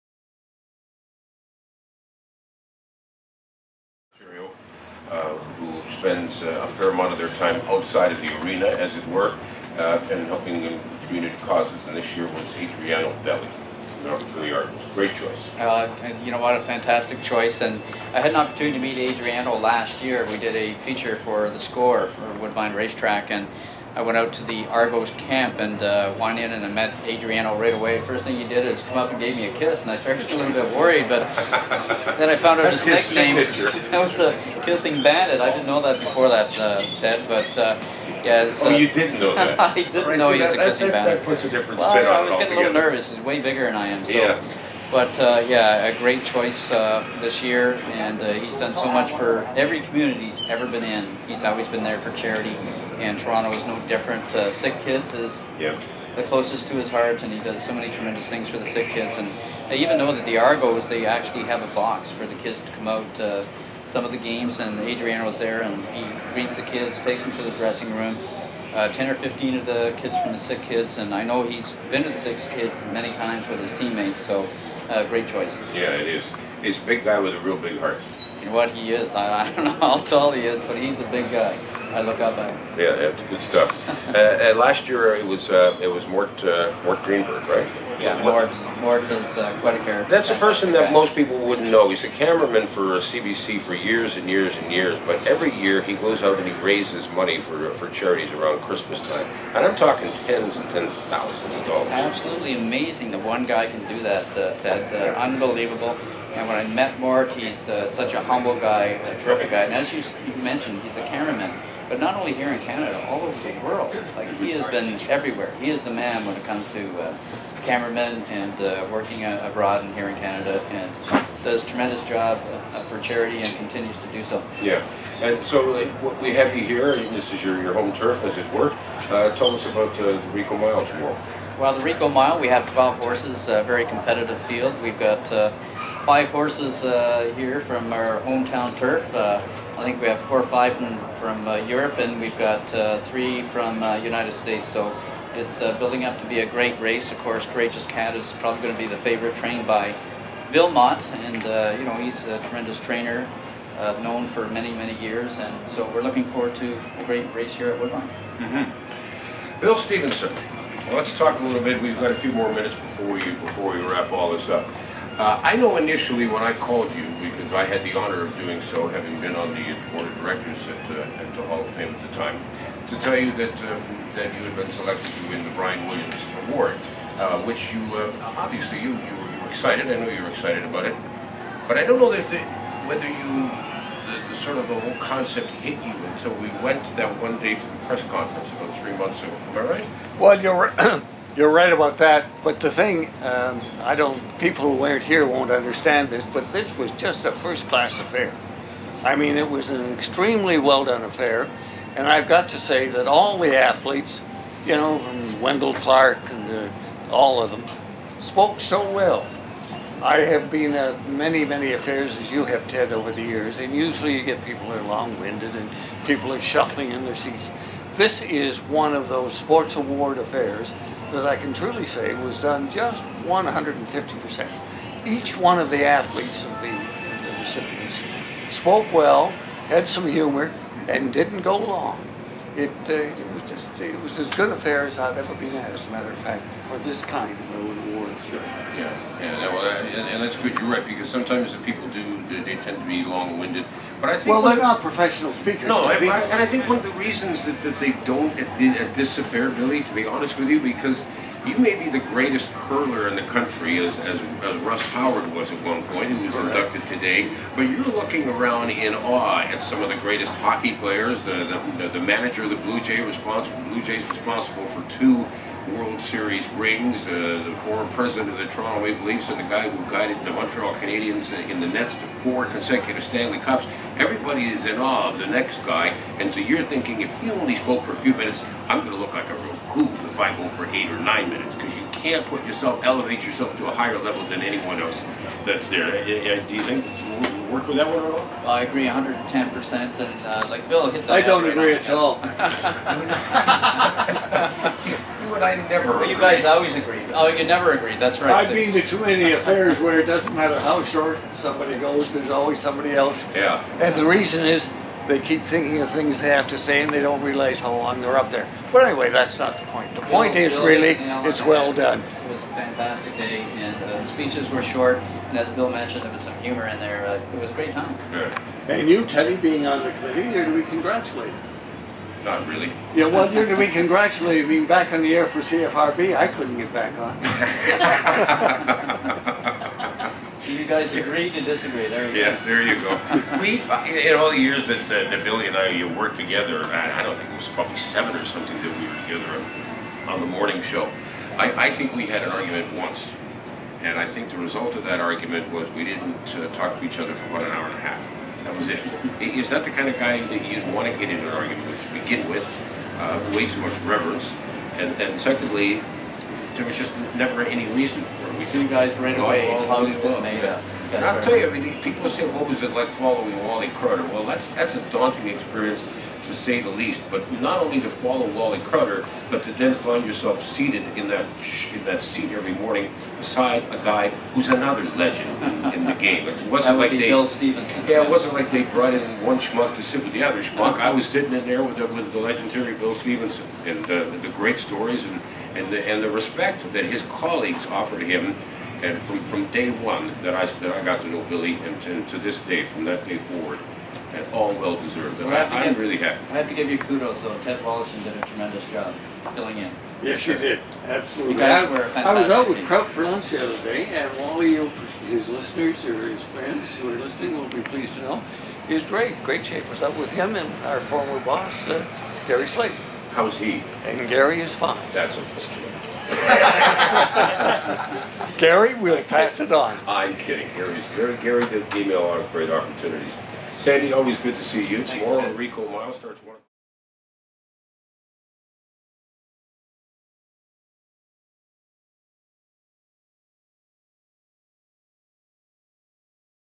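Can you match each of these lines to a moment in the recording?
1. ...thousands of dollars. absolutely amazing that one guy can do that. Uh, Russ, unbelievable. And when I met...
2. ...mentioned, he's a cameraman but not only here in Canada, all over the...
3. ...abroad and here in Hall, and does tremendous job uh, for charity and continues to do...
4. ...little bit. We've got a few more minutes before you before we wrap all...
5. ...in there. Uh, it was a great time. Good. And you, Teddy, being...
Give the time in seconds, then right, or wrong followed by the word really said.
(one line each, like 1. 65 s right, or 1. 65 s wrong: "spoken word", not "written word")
1. 101 s wrong: "Ted", not "Russ"
2. 110 s right
3. 119 s wrong: "Canada", not "Hall"
4. 161 s right
5. 316 s right.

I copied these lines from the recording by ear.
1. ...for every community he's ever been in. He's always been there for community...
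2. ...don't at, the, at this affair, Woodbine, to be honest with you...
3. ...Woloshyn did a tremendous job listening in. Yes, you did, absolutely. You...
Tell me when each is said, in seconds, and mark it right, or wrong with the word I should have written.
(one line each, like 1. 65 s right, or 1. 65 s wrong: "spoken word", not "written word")
1. 49 s wrong: "charity", not "community"
2. 248 s wrong: "Billy", not "Woodbine"
3. 397 s wrong: "filling", not "listening".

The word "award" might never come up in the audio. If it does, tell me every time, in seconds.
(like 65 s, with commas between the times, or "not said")
176 s, 219 s, 237 s.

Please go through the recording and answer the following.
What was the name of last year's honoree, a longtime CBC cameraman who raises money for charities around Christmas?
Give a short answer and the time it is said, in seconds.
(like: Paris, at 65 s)
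Mort Greenberg, at 86 s.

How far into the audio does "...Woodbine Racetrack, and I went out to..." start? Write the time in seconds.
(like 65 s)
22 s.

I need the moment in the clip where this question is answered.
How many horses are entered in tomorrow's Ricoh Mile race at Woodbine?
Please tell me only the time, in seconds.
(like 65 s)
132 s.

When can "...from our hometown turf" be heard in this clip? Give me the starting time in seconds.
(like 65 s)
137 s.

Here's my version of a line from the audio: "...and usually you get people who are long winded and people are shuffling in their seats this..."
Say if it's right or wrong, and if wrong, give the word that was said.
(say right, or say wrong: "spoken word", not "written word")
right.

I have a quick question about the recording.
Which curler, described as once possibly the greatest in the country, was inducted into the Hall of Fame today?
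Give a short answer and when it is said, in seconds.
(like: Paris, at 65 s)
Russ Howard, at 254 s.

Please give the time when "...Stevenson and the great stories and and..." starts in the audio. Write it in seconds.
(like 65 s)
382 s.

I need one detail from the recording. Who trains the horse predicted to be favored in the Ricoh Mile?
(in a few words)
Bill Mott.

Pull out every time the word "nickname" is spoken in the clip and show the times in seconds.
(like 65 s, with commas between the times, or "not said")
33 s.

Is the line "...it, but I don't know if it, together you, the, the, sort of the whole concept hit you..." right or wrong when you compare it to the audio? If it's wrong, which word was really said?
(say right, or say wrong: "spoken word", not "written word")
wrong: "whether", not "together".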